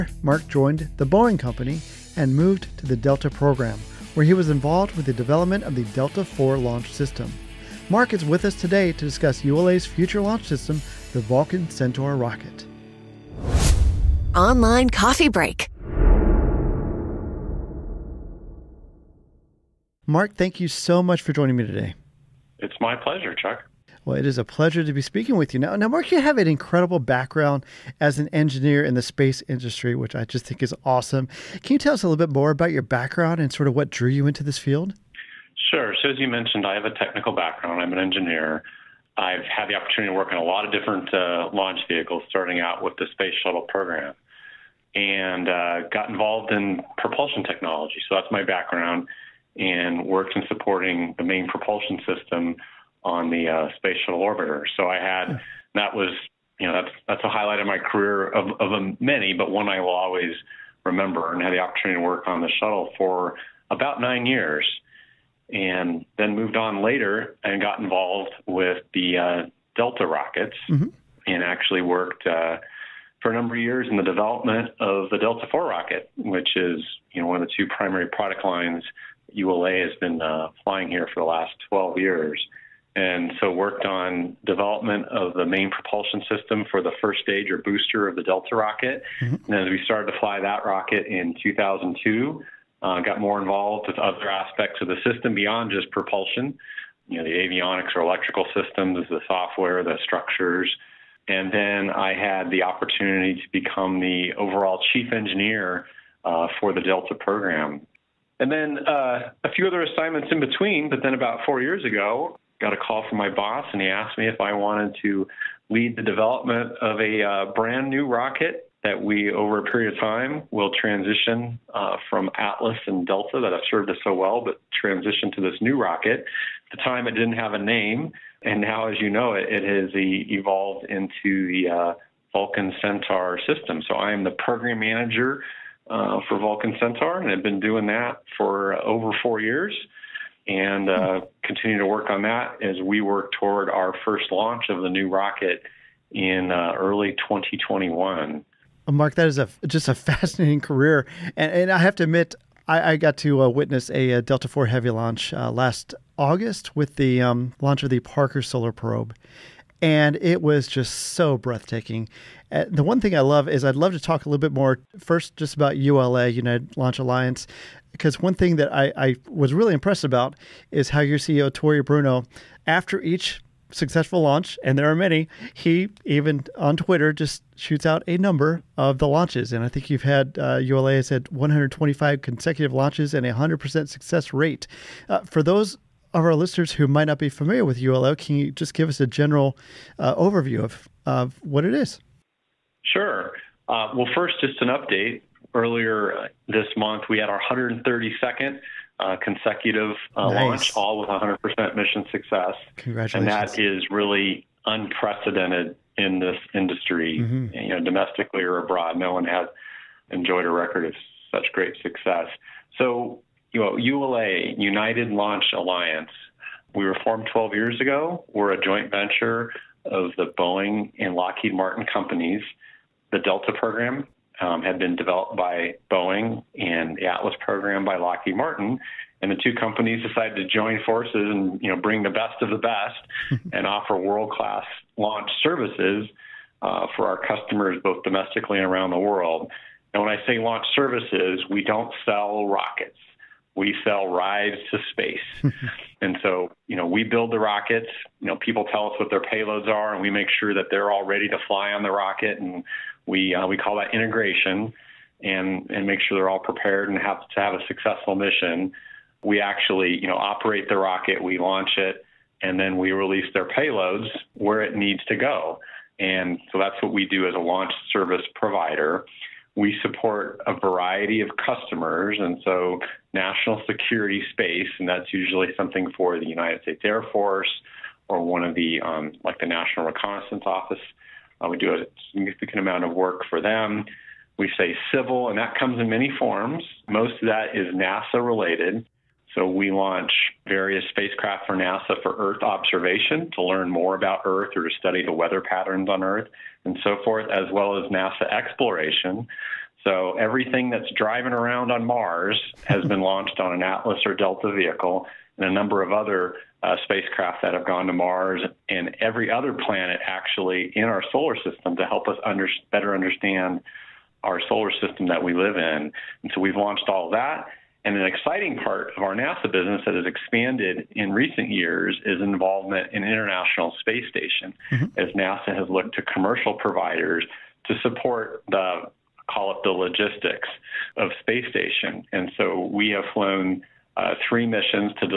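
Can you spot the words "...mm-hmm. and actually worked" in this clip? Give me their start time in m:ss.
1:10.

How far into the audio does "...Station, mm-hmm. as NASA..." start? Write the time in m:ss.
5:24.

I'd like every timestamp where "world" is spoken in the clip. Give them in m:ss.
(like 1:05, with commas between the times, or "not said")
3:53, 3:58.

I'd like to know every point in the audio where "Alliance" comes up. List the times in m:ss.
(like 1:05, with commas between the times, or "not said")
2:46, 3:35.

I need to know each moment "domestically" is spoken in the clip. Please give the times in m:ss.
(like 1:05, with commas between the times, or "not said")
3:27, 3:58.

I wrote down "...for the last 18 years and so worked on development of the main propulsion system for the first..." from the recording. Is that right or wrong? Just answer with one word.
wrong.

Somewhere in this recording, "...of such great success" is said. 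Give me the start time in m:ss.
3:30.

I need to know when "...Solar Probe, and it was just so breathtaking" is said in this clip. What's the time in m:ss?
2:38.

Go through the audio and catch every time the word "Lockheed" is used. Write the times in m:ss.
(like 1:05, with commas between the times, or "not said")
3:41, 3:47.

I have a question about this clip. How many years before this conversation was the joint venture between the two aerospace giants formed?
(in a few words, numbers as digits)
12 years.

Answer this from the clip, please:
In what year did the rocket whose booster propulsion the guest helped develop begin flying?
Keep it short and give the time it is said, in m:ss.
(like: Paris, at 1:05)
2002, at 1:31.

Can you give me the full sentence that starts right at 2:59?
And I think you've had, uh, ULA has had 125 consecutive launches and a 100% success rate.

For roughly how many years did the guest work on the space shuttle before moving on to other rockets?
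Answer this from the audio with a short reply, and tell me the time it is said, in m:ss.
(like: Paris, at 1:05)
9 years, at 1:03.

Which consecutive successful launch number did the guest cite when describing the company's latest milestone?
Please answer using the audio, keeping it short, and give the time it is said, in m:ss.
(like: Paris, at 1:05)
132nd, at 3:17.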